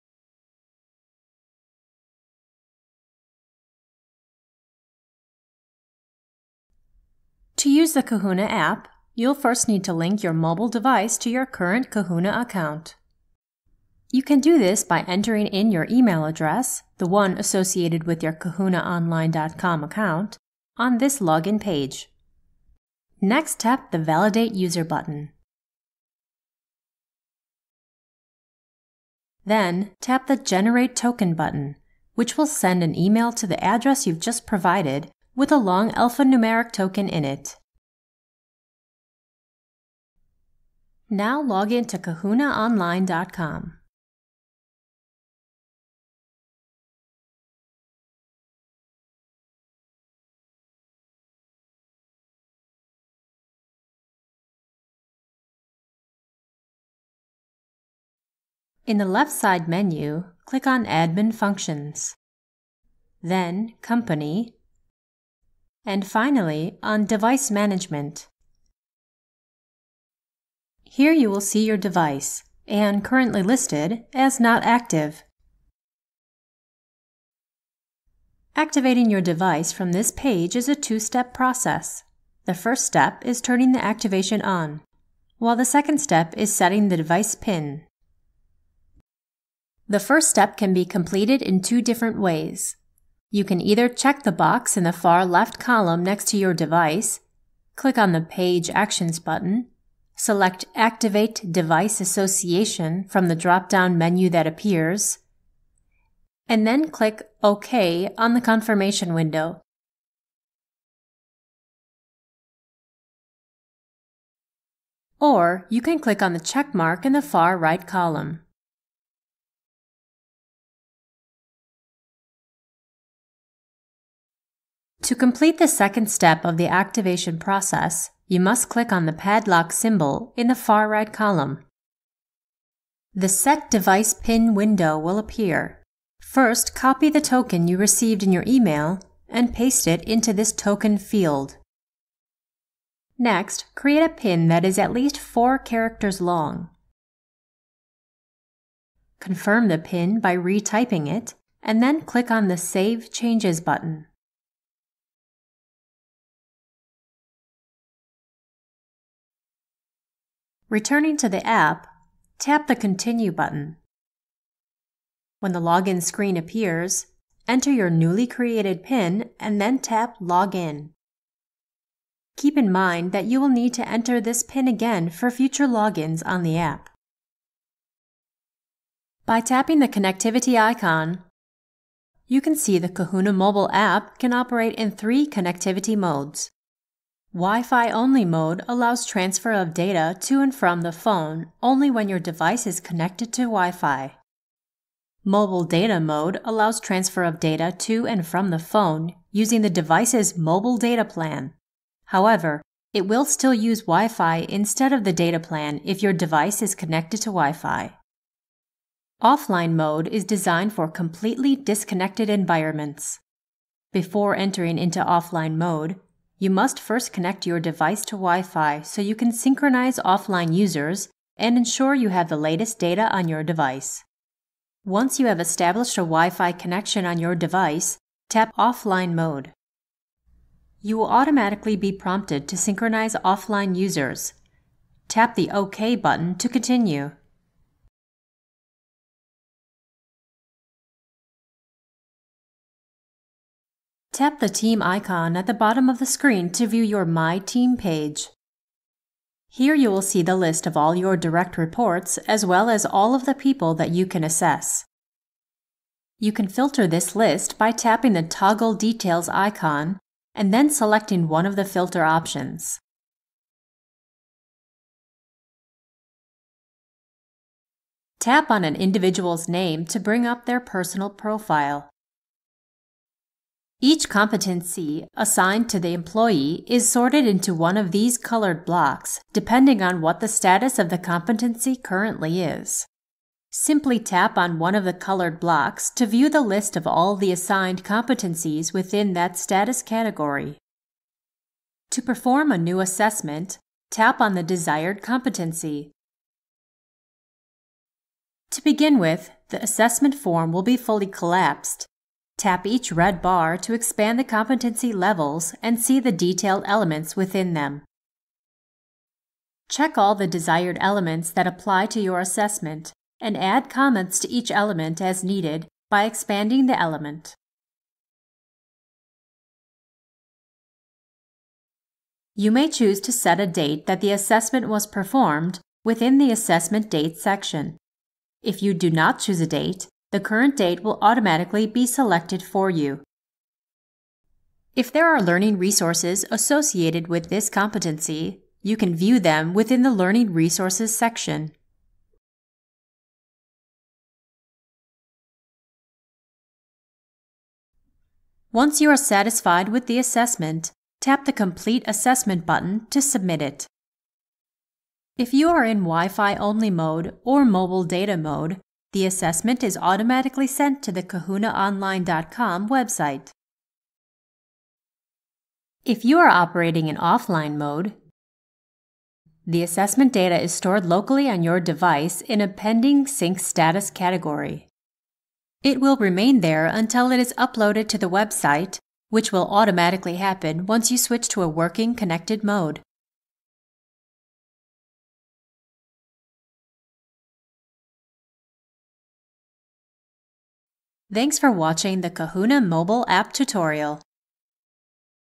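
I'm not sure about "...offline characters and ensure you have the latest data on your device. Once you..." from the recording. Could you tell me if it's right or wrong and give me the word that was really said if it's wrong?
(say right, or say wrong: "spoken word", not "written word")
wrong: "users", not "characters".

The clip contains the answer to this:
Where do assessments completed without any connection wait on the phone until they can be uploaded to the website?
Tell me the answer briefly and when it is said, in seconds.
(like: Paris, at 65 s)
pending sync, at 372 s.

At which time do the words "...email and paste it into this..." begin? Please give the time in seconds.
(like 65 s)
138 s.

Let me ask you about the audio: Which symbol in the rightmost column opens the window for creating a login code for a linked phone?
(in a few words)
padlock.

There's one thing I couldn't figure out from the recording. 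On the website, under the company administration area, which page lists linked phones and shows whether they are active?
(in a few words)
Device Management.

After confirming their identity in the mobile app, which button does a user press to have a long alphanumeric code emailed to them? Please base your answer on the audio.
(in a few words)
Generate Token.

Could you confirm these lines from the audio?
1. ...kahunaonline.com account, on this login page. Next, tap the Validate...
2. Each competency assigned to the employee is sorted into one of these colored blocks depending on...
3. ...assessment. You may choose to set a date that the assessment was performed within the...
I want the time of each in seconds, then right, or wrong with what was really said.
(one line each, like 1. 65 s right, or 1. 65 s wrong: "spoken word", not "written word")
1. 18 s right
2. 273 s right
3. 316 s wrong: "element", not "assessment".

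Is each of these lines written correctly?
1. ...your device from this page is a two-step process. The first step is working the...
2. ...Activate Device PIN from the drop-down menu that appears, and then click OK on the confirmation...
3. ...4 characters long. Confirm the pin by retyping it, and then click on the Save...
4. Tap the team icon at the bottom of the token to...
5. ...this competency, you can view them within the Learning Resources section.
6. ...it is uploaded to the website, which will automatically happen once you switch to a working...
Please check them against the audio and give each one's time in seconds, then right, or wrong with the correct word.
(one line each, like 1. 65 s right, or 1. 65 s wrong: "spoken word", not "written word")
1. 79 s wrong: "turning", not "working"
2. 100 s wrong: "Association", not "PIN"
3. 145 s right
4. 244 s wrong: "screen", not "token"
5. 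337 s right
6. 377 s right.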